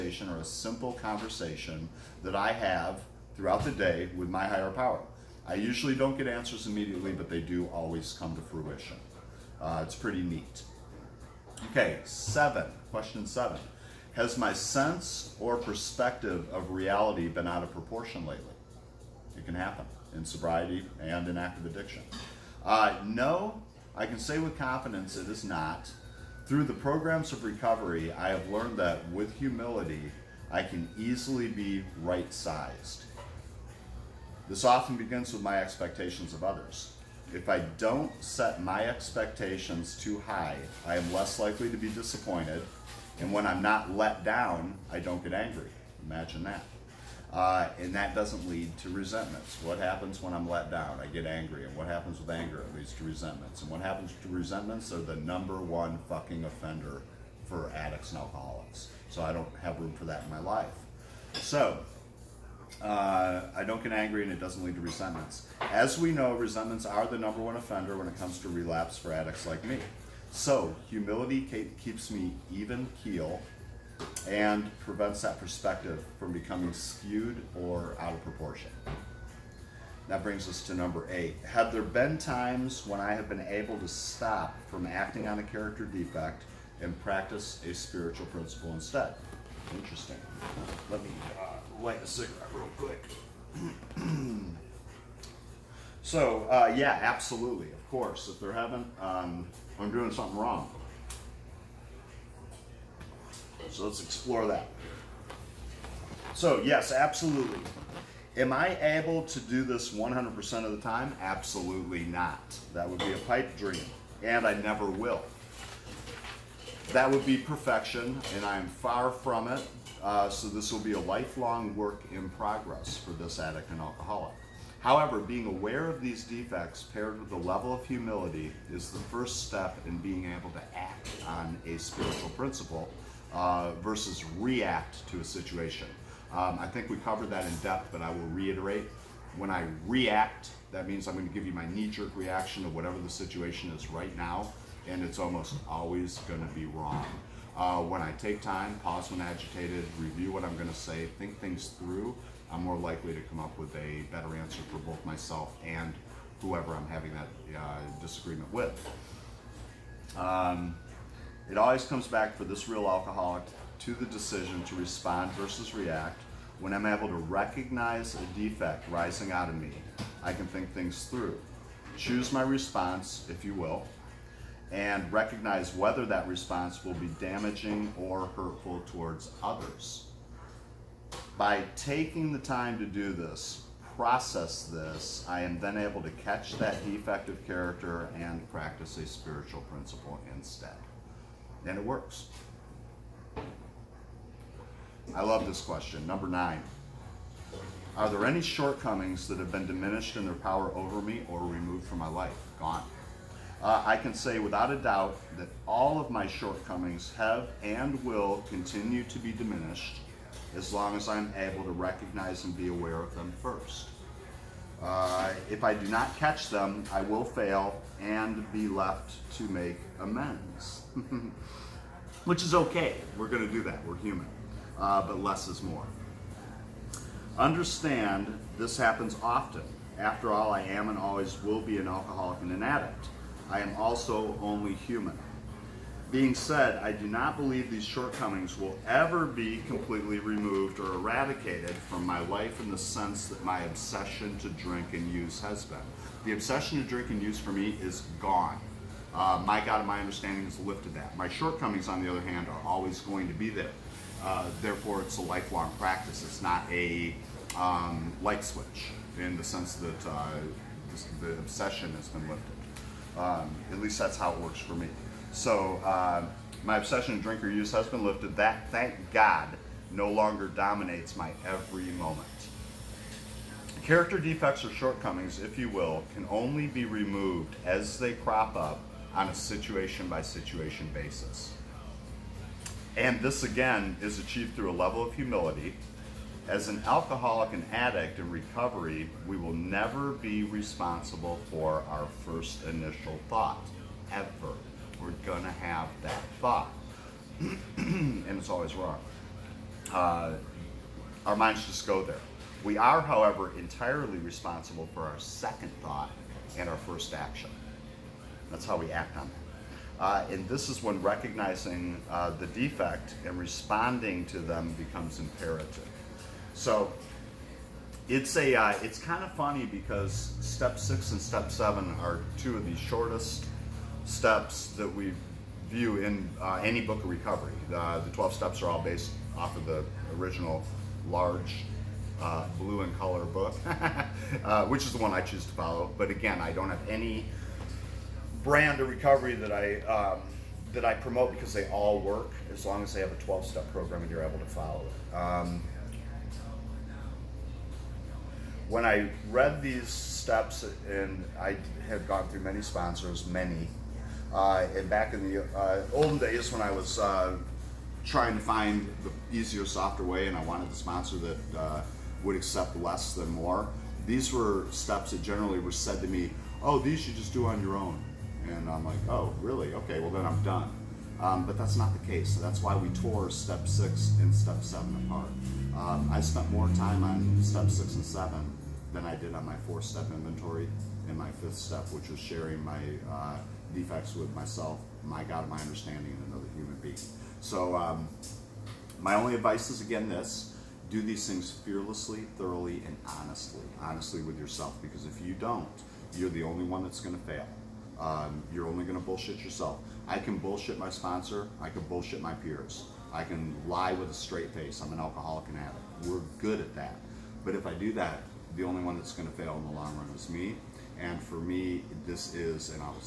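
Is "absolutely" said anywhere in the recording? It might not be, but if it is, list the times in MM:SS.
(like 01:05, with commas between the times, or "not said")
01:37, 01:46, 01:51.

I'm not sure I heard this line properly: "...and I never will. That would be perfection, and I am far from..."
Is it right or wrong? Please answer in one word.
right.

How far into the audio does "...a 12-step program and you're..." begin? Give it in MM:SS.
05:43.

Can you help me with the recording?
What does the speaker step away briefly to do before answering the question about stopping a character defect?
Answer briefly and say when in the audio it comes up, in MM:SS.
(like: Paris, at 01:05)
light a cigarette, at 01:31.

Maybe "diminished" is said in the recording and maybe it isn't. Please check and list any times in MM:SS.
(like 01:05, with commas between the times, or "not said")
03:19, 03:29.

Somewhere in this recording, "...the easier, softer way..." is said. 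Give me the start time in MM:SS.
05:59.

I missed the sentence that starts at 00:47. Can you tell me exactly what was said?
Uh, and that doesn't lead to resentments.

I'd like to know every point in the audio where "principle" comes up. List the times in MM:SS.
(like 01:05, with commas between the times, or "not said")
01:28, 02:12, 03:09.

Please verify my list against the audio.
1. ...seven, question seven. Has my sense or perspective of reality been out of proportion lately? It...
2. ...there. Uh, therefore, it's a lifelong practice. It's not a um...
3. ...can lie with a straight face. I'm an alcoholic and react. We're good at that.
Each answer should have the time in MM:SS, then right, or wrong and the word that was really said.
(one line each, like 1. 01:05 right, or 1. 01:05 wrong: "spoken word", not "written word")
1. 00:12 right
2. 04:13 right
3. 06:43 wrong: "addict", not "react".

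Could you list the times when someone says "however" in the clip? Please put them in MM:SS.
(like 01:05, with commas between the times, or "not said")
02:04, 05:03.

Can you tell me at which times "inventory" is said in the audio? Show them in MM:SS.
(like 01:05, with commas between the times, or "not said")
06:20.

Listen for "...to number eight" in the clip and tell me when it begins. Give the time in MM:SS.
01:20.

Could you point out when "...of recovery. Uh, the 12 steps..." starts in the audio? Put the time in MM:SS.
05:27.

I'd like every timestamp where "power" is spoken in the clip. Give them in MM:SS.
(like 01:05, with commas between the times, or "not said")
00:04, 03:20.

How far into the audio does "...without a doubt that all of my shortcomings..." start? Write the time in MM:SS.
03:24.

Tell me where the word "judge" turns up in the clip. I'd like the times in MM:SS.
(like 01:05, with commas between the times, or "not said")
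not said.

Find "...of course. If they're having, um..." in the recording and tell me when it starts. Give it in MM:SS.
01:37.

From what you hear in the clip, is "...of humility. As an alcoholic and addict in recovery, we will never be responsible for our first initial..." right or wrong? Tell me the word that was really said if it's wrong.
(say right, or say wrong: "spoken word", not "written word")
right.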